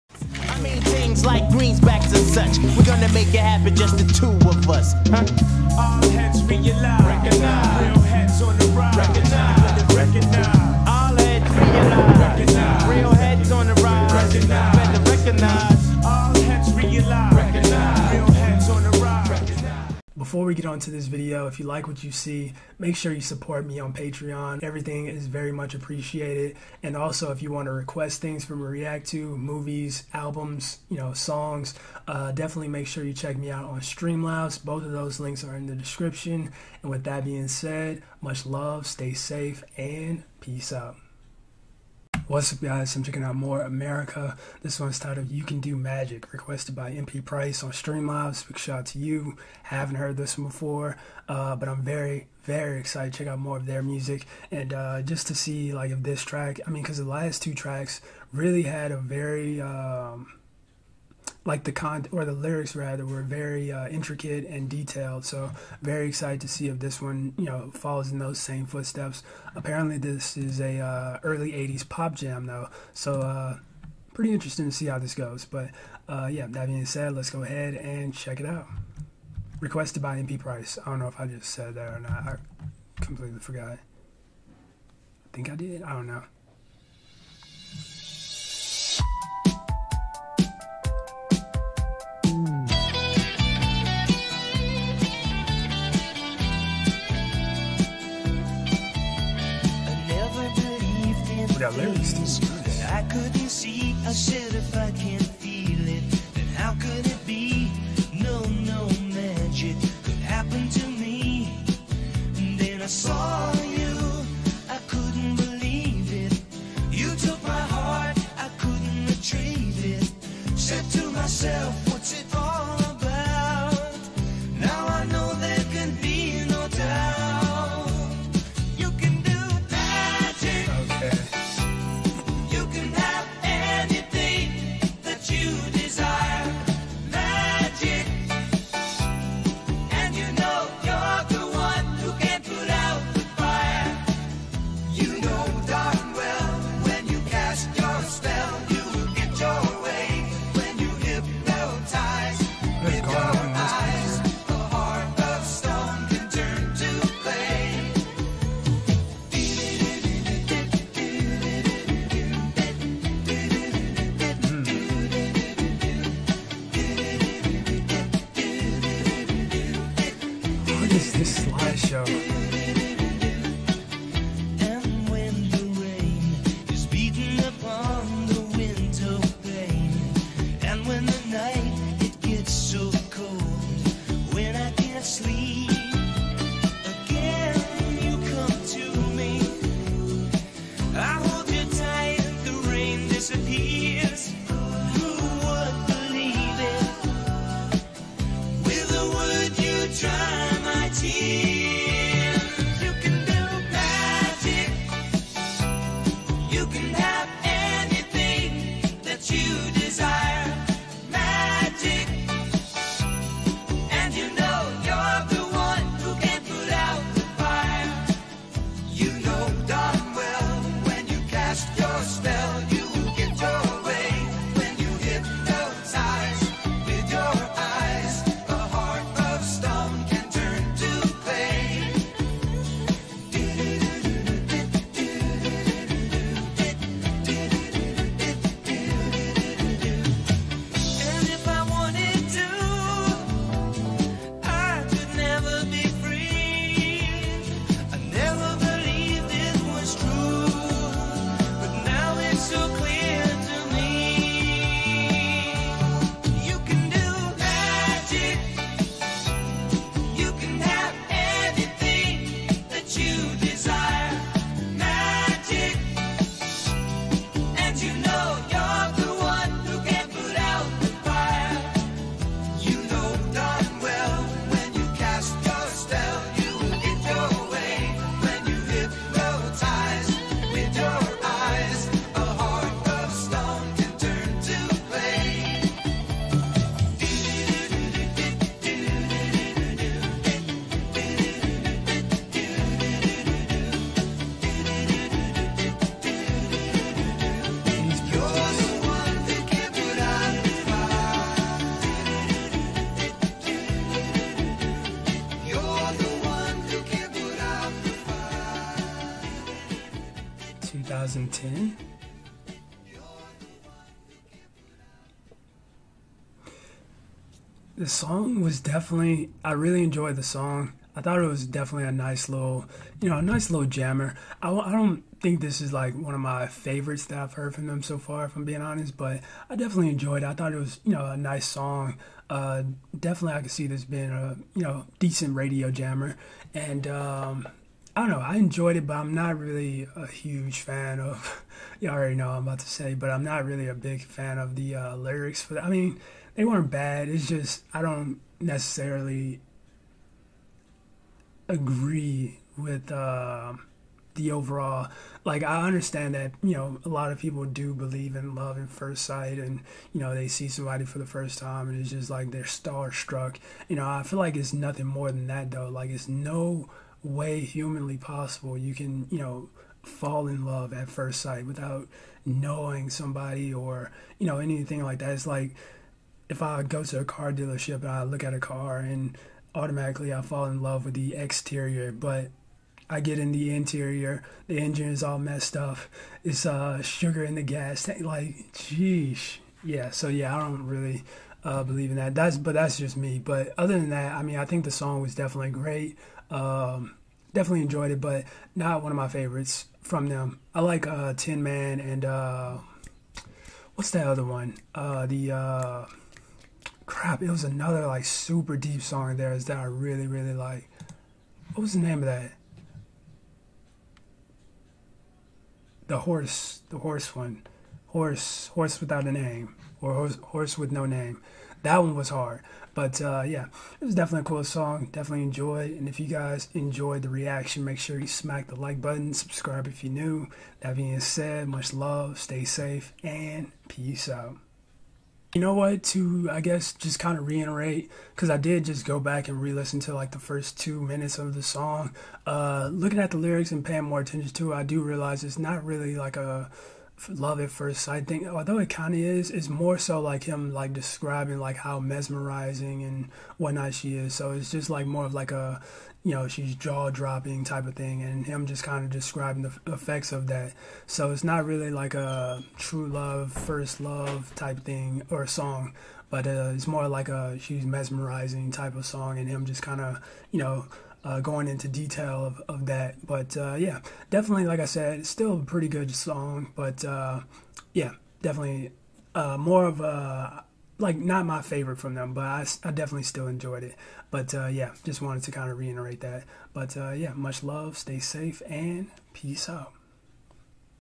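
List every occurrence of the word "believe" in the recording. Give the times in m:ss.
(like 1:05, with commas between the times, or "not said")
5:57, 6:31.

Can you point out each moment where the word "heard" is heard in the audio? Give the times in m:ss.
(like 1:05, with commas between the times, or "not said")
0:49, 5:27.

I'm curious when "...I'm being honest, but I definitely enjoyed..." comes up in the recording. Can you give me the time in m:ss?
5:28.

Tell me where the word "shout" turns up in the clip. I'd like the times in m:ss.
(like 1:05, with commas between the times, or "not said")
0:48.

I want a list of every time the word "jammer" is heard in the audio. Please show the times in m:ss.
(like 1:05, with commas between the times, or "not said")
5:23, 5:35.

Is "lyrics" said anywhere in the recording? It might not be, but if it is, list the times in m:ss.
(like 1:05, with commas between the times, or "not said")
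1:02, 5:44, 7:23.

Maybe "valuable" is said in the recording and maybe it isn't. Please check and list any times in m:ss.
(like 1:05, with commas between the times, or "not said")
not said.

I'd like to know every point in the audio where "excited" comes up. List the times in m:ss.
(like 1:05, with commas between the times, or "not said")
0:52, 1:06.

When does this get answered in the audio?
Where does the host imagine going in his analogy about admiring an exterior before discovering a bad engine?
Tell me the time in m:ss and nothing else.
6:17.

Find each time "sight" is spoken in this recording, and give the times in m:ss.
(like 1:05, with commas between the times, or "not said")
5:59, 6:11, 7:27.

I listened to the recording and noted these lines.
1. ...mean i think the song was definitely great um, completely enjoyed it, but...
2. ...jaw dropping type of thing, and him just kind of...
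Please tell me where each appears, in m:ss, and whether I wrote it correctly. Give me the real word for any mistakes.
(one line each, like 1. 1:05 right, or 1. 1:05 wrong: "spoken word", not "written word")
1. 6:34 wrong: "definitely", not "completely"
2. 7:36 right.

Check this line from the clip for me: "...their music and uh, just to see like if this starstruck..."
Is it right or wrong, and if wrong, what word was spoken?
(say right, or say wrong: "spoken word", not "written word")
wrong: "track", not "starstruck".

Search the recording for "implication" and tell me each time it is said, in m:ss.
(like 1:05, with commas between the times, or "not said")
not said.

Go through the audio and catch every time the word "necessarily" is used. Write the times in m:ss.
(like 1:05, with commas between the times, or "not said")
5:48.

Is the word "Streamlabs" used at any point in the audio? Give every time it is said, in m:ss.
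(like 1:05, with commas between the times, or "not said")
0:33, 0:47.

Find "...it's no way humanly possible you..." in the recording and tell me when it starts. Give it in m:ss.
6:05.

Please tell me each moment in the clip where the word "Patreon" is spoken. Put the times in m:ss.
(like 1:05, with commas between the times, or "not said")
0:23.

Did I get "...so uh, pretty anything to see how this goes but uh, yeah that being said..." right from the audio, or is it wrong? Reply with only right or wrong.
wrong.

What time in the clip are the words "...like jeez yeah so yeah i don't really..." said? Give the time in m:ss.
6:28.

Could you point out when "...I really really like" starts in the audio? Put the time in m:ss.
6:49.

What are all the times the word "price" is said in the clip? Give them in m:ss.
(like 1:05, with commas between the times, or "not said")
0:47, 1:20.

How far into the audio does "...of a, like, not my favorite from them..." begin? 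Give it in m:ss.
7:59.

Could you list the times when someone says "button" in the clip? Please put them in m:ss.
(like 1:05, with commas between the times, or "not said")
7:08.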